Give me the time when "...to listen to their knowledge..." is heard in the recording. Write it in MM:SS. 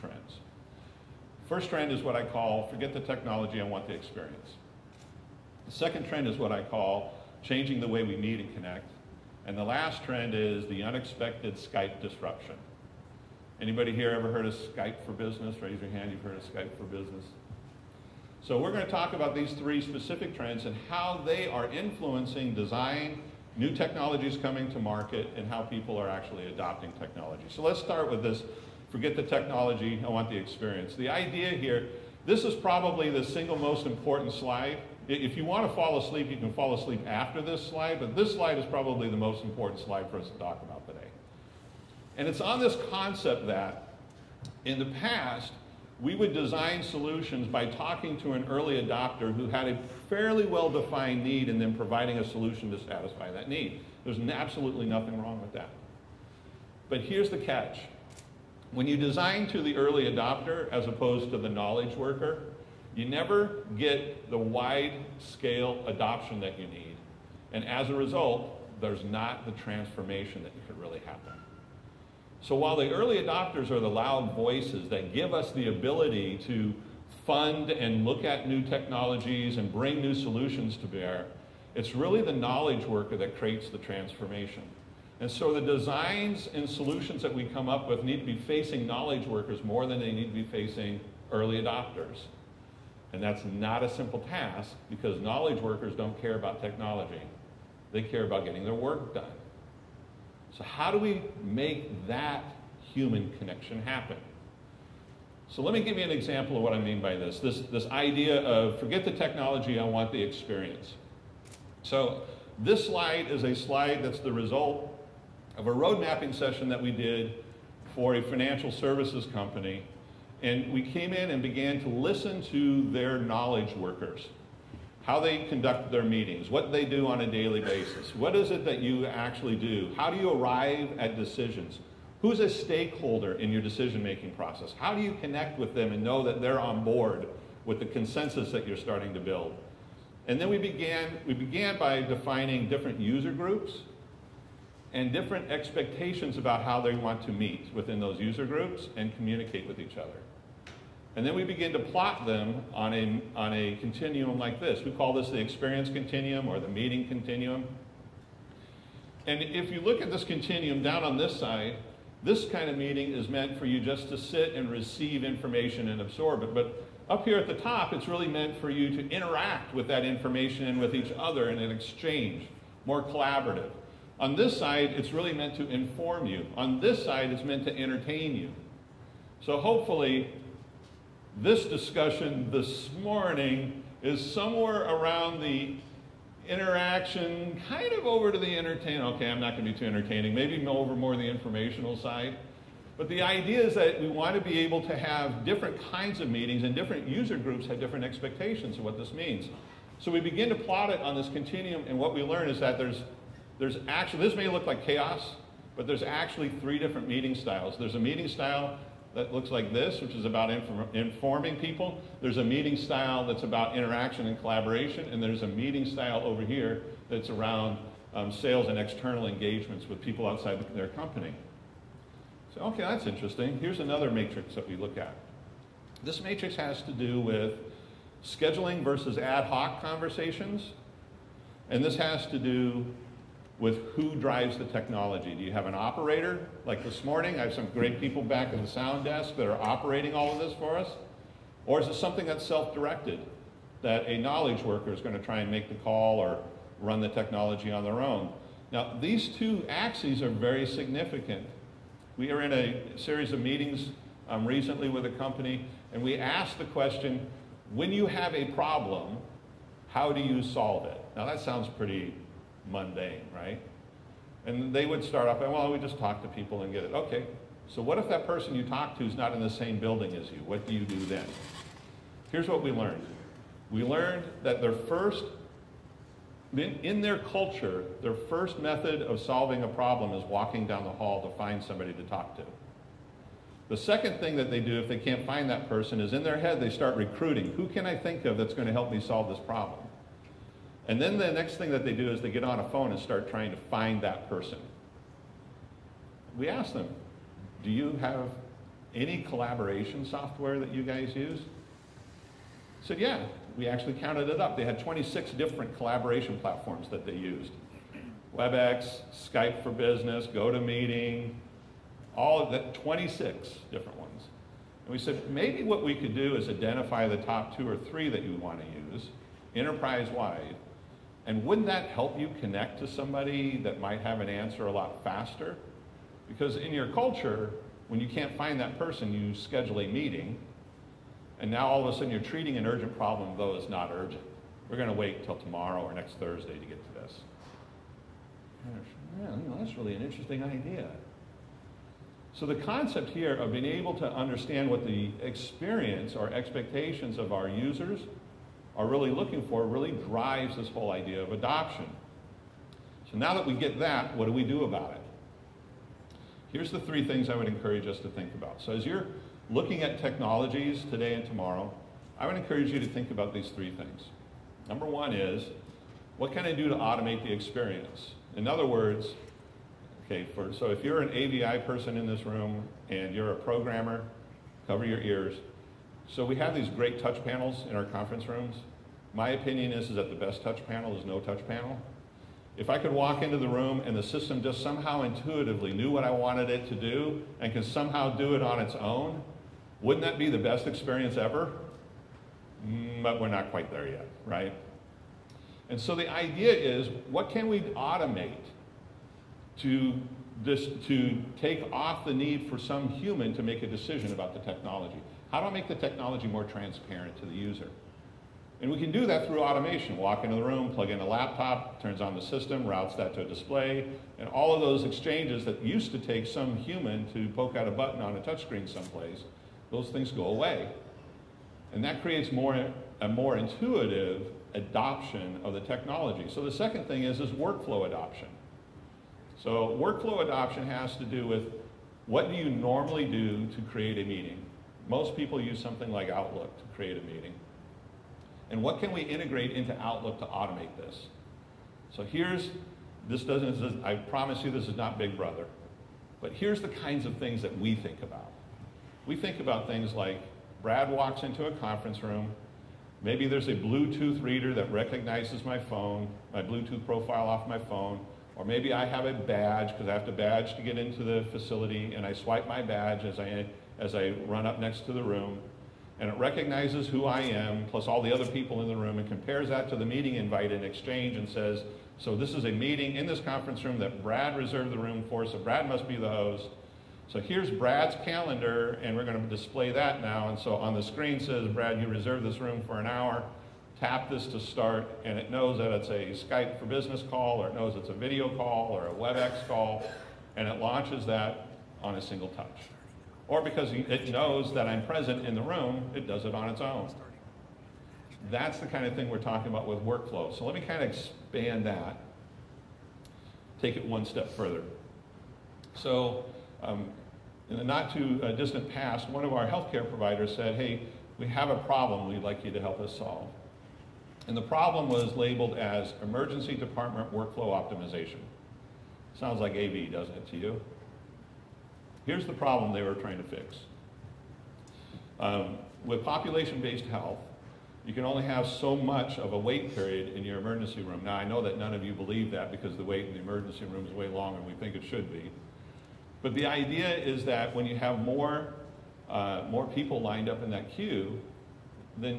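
02:01.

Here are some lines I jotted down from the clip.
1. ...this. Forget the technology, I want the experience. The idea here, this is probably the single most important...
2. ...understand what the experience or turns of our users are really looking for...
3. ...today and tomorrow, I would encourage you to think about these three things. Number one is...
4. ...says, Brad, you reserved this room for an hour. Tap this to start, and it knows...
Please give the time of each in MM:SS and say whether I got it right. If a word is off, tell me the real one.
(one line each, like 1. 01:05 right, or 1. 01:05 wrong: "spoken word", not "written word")
1. 00:28 right
2. 05:44 wrong: "expectations", not "turns"
3. 06:00 right
4. 08:01 right.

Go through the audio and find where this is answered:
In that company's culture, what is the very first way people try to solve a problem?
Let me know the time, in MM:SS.
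04:40.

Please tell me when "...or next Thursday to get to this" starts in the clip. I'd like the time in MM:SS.
05:35.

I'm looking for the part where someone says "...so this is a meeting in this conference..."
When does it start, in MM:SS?
07:51.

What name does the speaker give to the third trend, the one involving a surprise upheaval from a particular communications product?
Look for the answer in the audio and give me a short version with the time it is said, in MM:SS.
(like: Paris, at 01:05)
The unexpected Skype disruption, at 00:10.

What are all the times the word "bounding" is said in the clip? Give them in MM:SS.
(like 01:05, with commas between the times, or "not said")
not said.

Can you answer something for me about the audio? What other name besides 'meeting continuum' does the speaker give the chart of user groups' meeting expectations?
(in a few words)
Experience continuum.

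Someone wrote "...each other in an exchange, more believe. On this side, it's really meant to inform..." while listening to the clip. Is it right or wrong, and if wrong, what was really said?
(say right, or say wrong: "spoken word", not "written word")
wrong: "collaborative", not "believe".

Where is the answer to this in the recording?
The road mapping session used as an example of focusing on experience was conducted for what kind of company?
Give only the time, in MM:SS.
01:58.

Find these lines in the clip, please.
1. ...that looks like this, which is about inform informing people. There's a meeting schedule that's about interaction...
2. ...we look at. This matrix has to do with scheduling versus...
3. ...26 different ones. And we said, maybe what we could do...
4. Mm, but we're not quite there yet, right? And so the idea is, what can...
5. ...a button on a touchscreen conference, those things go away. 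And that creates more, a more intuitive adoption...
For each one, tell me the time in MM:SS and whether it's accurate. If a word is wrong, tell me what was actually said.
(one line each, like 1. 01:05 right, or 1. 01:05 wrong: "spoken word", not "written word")
1. 03:29 wrong: "style", not "schedule"
2. 03:44 right
3. 05:12 right
4. 06:32 right
5. 06:57 wrong: "someplace", not "conference".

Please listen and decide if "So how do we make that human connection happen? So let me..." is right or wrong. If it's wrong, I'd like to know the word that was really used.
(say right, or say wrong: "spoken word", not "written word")
right.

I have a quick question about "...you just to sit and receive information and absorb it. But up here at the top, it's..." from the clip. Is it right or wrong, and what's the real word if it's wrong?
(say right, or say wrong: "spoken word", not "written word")
right.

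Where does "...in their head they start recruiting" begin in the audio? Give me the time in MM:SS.
04:46.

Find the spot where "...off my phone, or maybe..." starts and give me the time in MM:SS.
07:37.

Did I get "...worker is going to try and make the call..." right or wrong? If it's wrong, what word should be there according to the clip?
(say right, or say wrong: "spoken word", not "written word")
right.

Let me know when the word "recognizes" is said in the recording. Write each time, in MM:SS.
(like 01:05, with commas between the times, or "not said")
07:34, 07:46.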